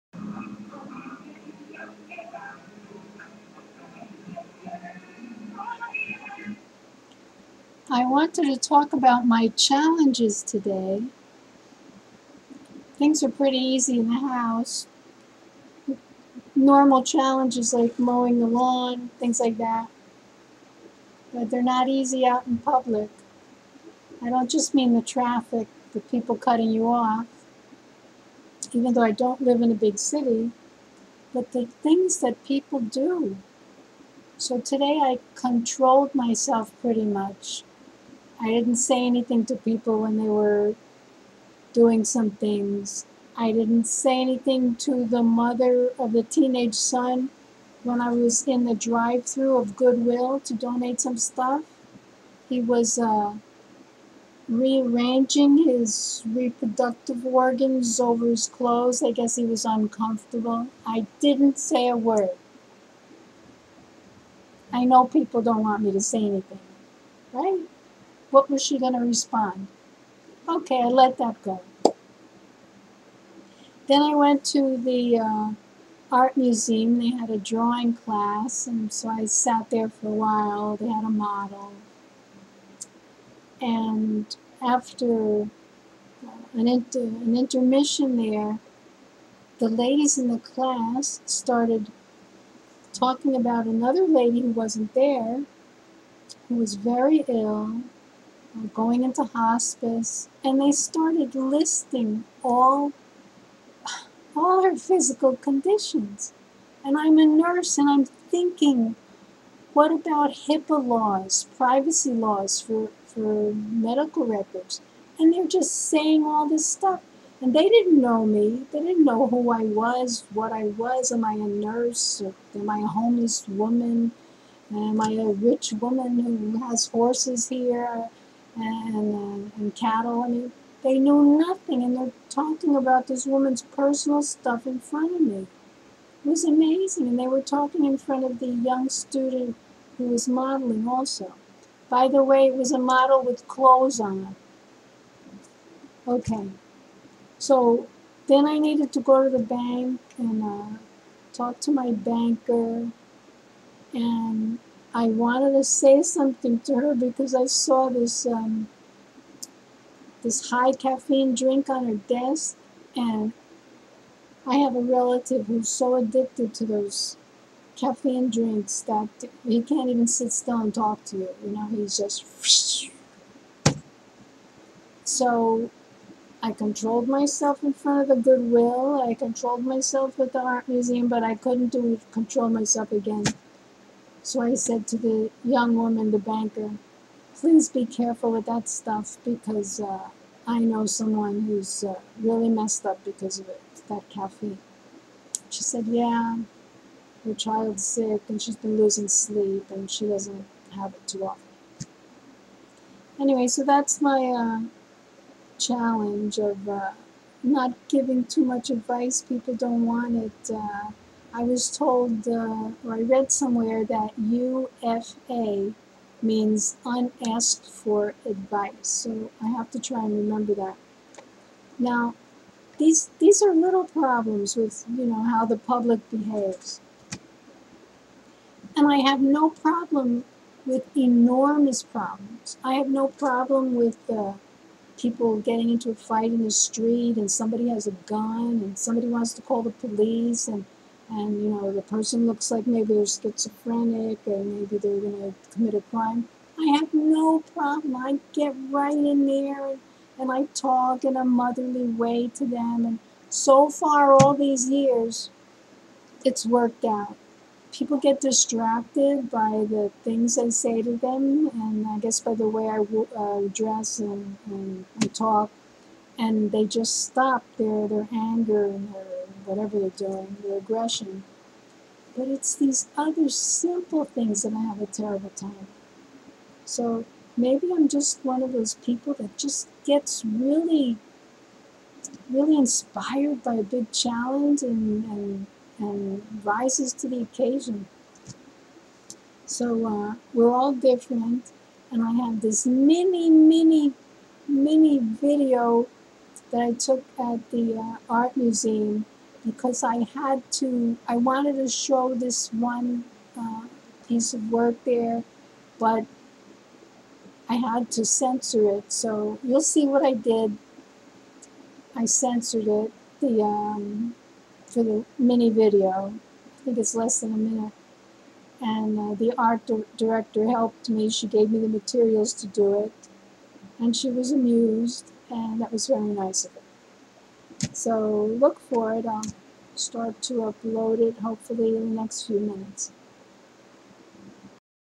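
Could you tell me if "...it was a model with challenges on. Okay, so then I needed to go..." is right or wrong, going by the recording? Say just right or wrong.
wrong.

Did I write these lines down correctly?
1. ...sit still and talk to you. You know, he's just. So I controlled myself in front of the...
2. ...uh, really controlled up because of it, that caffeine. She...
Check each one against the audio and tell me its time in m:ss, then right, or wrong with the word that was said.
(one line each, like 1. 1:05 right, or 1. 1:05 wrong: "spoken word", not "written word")
1. 2:50 right
2. 3:11 wrong: "messed", not "controlled".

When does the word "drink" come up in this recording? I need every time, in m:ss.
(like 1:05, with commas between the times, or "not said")
2:41, 2:48.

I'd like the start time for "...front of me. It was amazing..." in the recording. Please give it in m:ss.
2:14.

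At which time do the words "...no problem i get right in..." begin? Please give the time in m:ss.
4:06.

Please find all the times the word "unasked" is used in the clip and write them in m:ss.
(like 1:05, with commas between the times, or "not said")
3:36.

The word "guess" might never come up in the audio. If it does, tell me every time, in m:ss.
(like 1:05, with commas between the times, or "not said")
0:59, 4:21.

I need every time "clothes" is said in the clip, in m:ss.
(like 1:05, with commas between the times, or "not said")
0:58, 2:23.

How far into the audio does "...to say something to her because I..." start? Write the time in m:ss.
2:35.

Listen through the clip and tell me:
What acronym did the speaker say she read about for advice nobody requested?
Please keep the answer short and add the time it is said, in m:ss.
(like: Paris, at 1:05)
UFA, at 3:34.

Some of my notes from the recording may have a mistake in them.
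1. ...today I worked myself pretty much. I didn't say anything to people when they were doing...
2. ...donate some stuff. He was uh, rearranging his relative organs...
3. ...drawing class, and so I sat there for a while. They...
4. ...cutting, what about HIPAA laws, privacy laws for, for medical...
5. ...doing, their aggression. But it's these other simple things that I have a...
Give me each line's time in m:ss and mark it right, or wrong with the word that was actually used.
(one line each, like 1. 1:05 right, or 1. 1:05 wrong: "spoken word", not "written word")
1. 0:34 wrong: "controlled", not "worked"
2. 0:50 wrong: "reproductive", not "relative"
3. 1:17 right
4. 1:48 wrong: "thinking", not "cutting"
5. 4:29 right.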